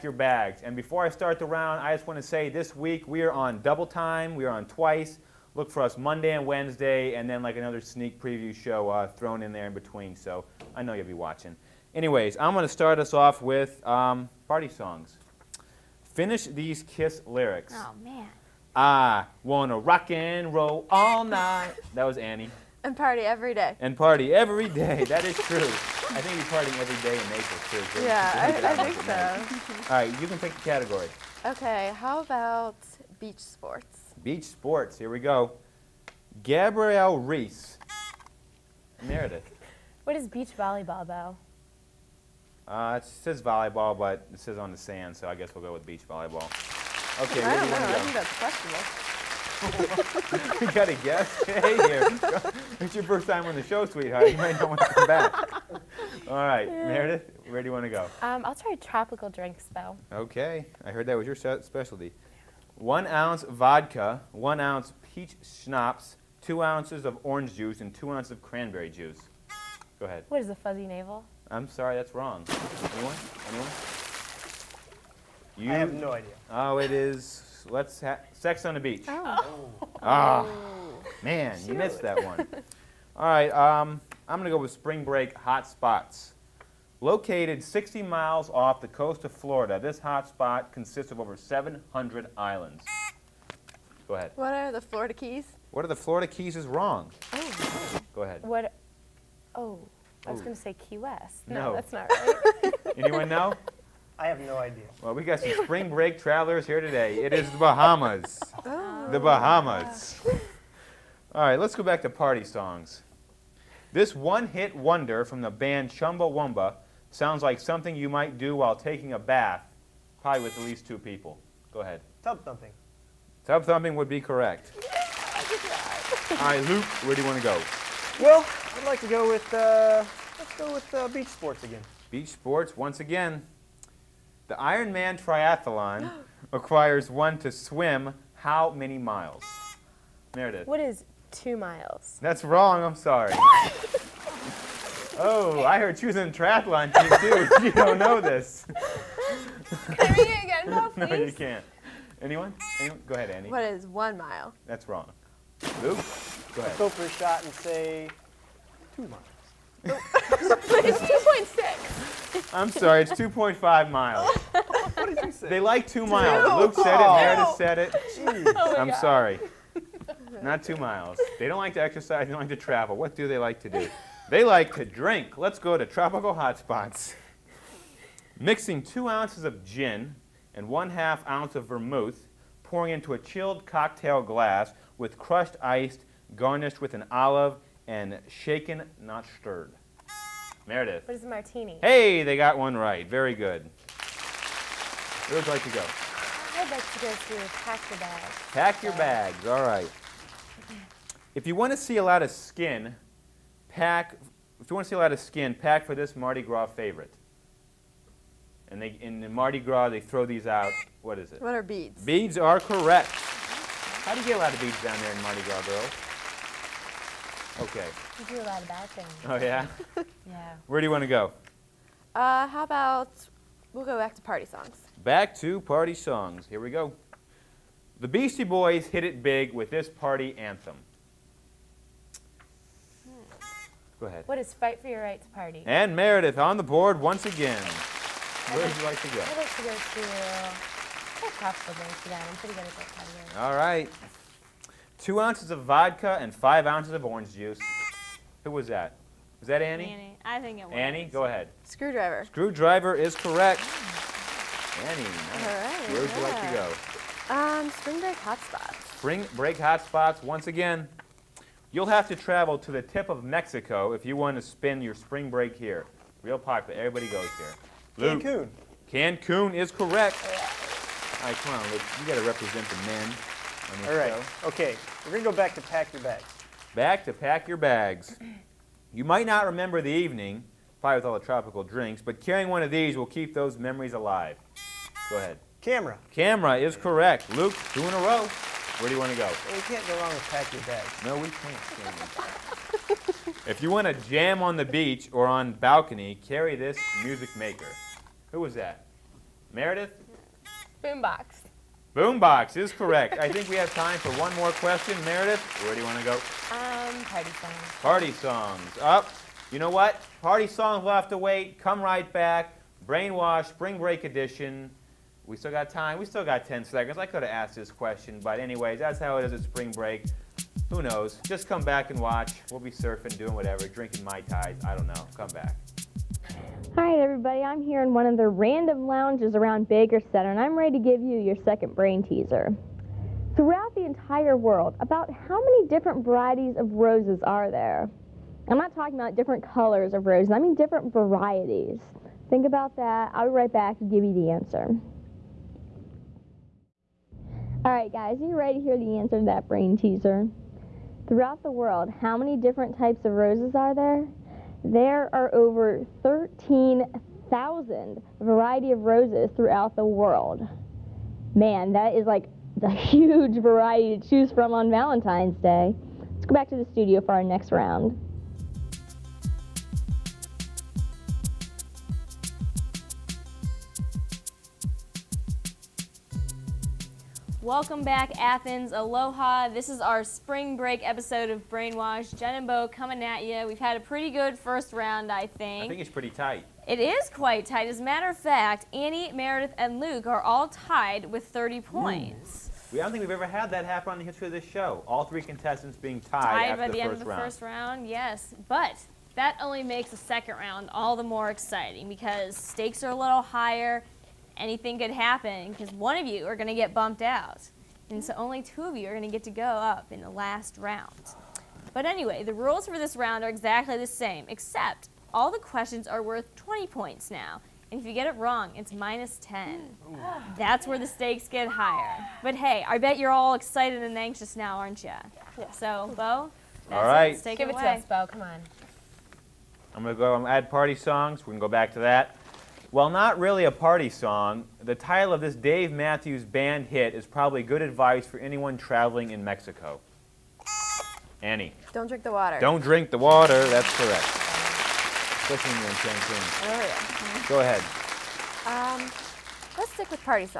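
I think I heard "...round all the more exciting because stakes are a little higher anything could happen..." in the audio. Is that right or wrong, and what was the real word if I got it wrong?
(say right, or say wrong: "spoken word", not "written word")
right.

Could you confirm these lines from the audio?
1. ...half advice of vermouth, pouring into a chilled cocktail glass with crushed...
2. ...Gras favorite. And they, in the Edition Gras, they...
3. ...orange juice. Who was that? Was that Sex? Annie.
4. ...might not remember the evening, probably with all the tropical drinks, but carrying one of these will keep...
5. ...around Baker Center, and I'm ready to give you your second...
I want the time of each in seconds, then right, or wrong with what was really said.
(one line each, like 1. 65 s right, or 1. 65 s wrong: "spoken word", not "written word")
1. 180 s wrong: "ounce", not "advice"
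2. 206 s wrong: "Mardi", not "Edition"
3. 247 s wrong: "Annie", not "Sex"
4. 279 s right
5. 329 s right.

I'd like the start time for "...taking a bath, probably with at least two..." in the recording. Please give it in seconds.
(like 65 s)
118 s.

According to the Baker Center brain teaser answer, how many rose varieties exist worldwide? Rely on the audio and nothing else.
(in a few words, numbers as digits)
Over 13,000.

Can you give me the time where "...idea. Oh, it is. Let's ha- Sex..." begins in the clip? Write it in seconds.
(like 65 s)
76 s.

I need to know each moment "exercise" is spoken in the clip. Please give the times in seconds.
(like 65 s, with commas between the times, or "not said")
171 s.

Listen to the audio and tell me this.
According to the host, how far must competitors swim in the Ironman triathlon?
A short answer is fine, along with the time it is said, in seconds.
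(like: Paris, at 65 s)
2.5 miles, at 163 s.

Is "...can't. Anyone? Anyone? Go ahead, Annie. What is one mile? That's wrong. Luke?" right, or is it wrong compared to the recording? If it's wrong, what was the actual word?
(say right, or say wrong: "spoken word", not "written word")
right.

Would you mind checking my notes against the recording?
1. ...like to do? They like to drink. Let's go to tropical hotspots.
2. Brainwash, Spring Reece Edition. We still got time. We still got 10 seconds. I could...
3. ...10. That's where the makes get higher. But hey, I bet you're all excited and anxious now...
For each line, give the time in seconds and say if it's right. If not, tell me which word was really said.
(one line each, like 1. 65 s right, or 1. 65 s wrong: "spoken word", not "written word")
1. 173 s right
2. 312 s wrong: "Break", not "Reece"
3. 419 s wrong: "stakes", not "makes".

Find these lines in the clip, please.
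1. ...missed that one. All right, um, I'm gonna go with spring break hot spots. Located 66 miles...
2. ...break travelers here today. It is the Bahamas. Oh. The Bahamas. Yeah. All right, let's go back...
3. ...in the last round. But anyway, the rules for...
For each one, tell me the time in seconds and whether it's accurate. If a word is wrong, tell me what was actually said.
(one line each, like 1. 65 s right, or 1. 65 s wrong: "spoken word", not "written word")
1. 81 s wrong: "60", not "66"
2. 105 s right
3. 409 s right.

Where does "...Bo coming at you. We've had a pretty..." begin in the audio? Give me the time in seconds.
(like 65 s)
382 s.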